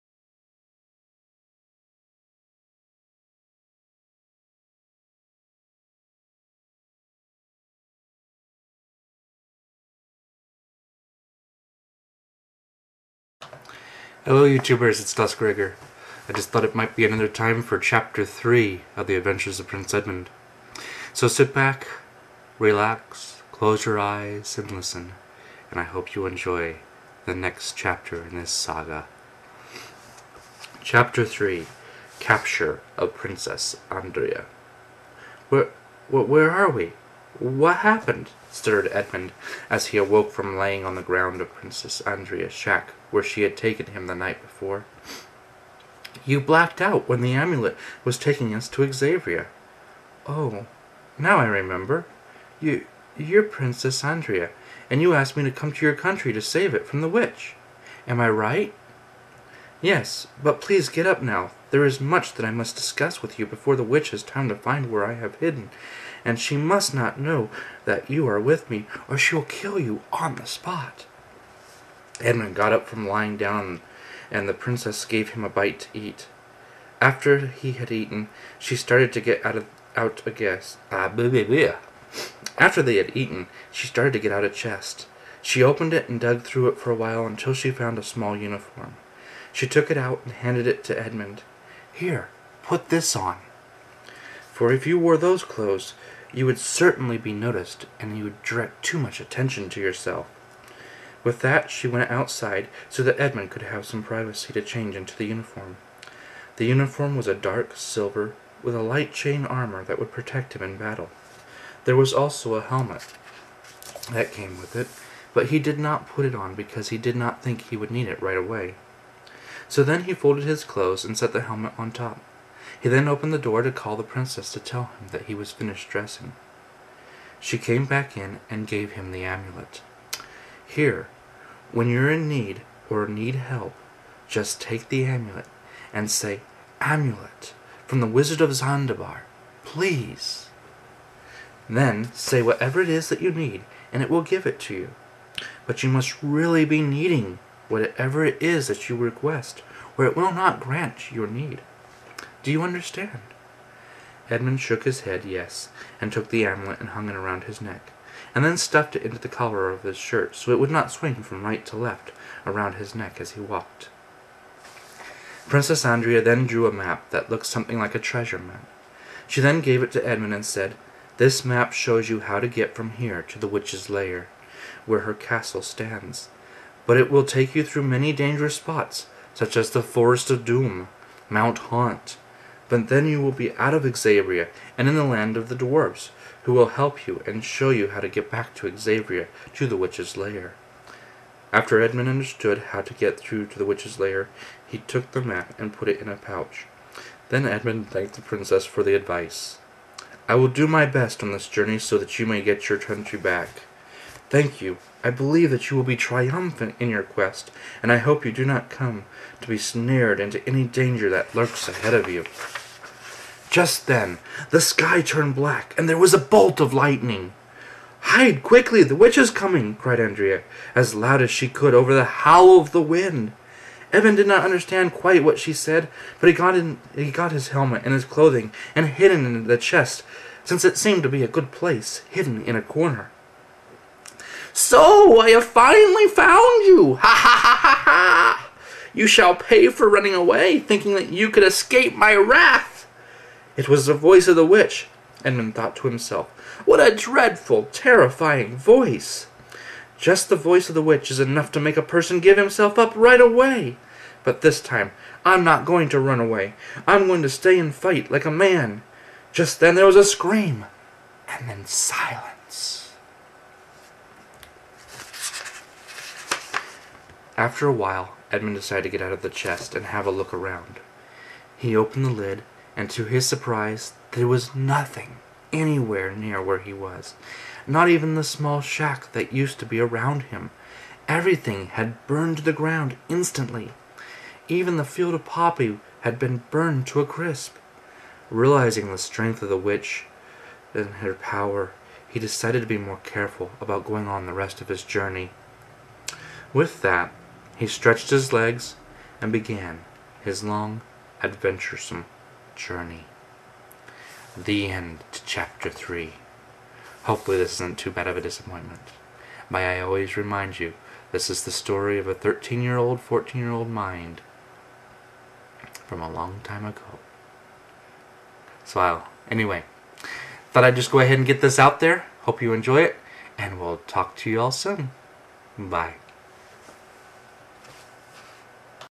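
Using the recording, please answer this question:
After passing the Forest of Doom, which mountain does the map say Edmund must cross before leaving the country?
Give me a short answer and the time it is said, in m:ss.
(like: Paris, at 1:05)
Mount Haunt, at 3:01.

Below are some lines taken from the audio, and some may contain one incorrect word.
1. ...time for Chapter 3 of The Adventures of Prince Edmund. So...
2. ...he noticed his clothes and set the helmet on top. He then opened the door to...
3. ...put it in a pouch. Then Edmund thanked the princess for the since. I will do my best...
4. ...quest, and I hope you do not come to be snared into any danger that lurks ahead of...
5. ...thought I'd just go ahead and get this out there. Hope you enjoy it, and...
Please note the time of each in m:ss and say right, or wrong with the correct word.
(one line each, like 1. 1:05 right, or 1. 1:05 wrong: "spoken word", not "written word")
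1. 0:17 right
2. 2:00 wrong: "folded", not "noticed"
3. 3:15 wrong: "advice", not "since"
4. 3:27 right
5. 5:20 right.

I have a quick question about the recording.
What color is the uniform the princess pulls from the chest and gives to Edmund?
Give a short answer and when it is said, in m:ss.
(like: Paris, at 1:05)
dark silver, at 1:47.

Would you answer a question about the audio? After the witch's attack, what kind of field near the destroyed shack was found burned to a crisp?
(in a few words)
poppy.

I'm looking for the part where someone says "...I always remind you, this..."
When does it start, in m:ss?
5:09.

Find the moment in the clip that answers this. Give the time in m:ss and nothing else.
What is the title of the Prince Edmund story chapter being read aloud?
0:32.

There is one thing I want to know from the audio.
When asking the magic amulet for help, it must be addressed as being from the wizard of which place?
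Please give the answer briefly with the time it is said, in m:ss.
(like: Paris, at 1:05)
Zandabar, at 2:18.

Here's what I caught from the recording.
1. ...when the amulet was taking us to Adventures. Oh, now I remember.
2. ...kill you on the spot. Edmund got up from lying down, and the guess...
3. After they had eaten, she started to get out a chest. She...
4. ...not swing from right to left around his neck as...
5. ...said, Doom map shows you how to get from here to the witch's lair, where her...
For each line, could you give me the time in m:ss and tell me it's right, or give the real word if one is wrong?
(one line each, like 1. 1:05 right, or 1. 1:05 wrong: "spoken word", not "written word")
1. 0:47 wrong: "Xavier", not "Adventures"
2. 1:09 wrong: "princess", not "guess"
3. 1:22 right
4. 2:40 right
5. 2:50 wrong: "This", not "Doom".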